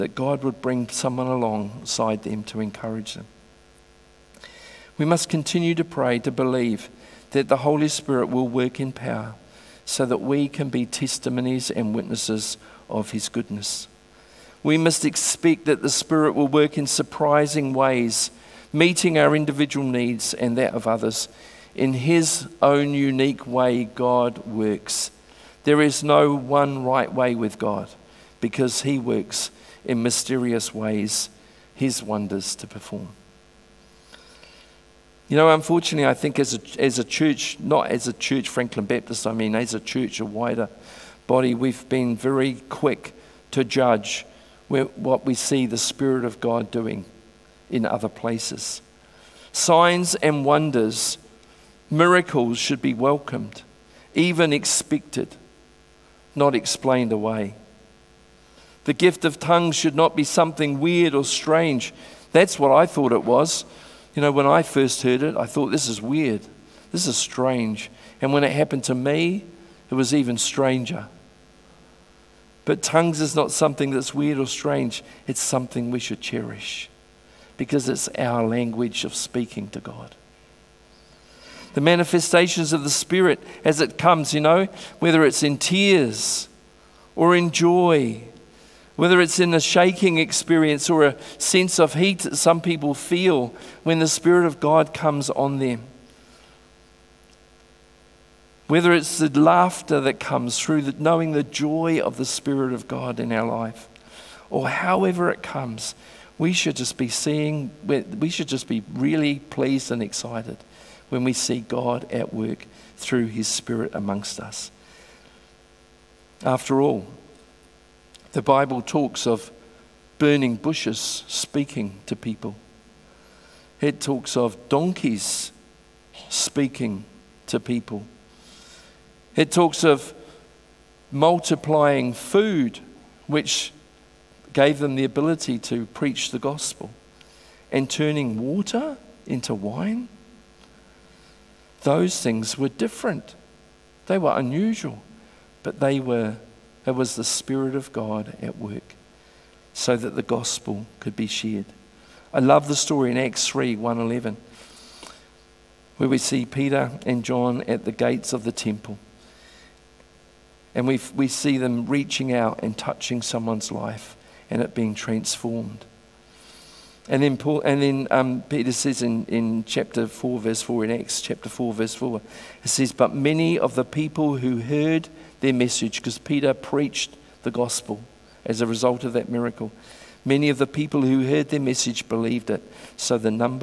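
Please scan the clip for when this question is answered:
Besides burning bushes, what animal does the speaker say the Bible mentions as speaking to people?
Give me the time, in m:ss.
2:04.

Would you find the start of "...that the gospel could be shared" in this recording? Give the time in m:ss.
2:29.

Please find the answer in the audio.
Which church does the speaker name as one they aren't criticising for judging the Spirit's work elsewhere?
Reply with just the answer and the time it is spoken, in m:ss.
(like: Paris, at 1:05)
Franklin Baptist, at 0:38.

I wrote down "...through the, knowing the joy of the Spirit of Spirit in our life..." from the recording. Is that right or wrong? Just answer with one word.
wrong.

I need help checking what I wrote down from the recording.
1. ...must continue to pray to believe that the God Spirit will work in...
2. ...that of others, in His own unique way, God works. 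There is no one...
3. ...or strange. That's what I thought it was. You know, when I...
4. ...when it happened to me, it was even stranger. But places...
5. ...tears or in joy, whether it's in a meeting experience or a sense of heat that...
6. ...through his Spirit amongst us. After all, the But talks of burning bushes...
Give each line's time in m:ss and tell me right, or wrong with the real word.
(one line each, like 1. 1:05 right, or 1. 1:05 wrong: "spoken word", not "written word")
1. 0:05 wrong: "Holy", not "God"
2. 0:20 right
3. 1:01 right
4. 1:08 wrong: "tongues", not "places"
5. 1:25 wrong: "shaking", not "meeting"
6. 1:52 wrong: "Bible", not "But".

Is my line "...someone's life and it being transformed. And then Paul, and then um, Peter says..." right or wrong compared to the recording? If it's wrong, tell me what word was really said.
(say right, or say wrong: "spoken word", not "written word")
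right.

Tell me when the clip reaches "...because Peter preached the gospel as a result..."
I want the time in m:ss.
2:55.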